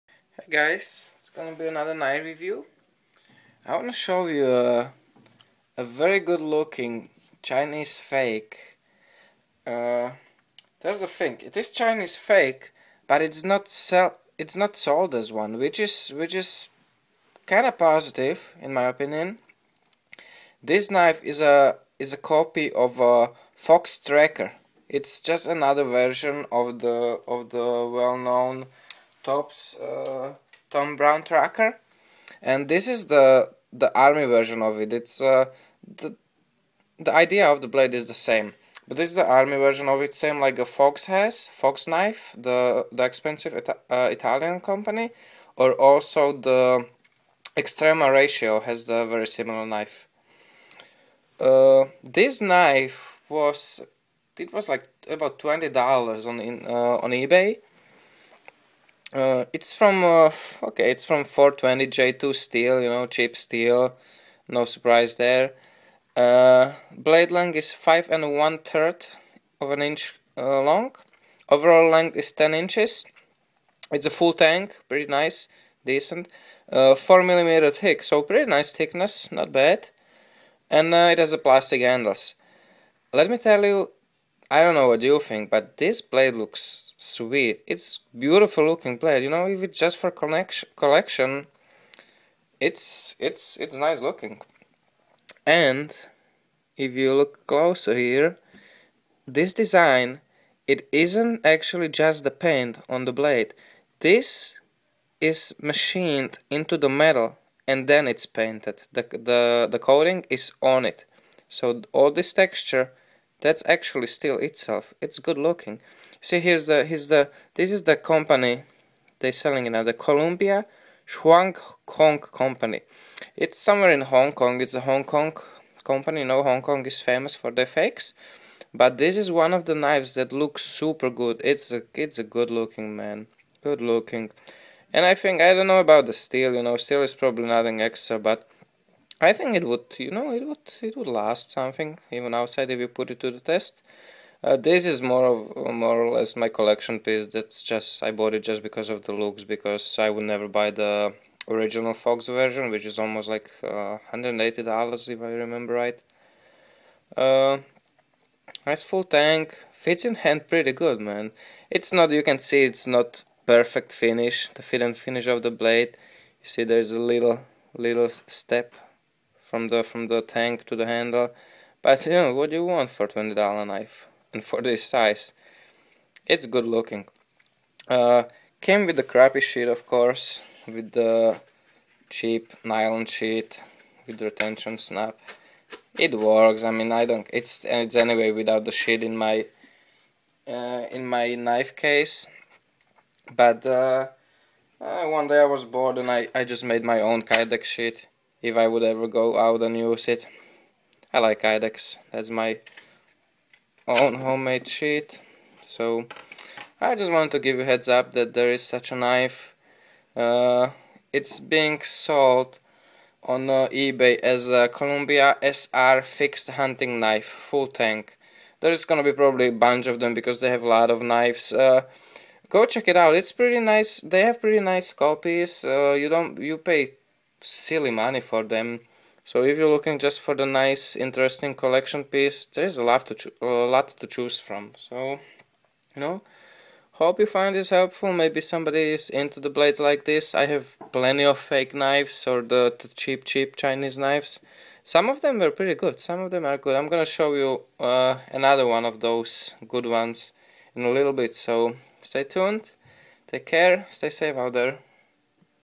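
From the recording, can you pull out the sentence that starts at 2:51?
But you know what do you want for twenty dollar knife and for this size?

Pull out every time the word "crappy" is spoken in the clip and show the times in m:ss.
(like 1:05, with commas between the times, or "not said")
2:59.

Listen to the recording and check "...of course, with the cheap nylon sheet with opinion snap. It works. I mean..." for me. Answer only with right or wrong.
wrong.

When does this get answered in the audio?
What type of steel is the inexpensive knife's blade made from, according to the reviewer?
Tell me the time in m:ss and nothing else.
1:01.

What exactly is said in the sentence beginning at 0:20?
This knife is a is a copy of a Fox Tracker.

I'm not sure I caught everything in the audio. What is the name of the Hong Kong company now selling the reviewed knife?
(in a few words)
Columbia Shuang Kong Company.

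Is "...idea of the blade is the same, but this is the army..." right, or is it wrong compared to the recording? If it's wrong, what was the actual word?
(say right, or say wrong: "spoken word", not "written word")
right.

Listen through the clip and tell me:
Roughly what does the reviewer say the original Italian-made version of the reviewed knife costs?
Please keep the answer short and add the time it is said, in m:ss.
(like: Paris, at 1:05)
$180, at 2:34.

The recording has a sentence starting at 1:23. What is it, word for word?
Let me tell you I don't know what you think, but this blade looks sweet.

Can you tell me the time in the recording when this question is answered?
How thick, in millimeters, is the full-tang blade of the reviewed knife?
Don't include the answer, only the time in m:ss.
1:16.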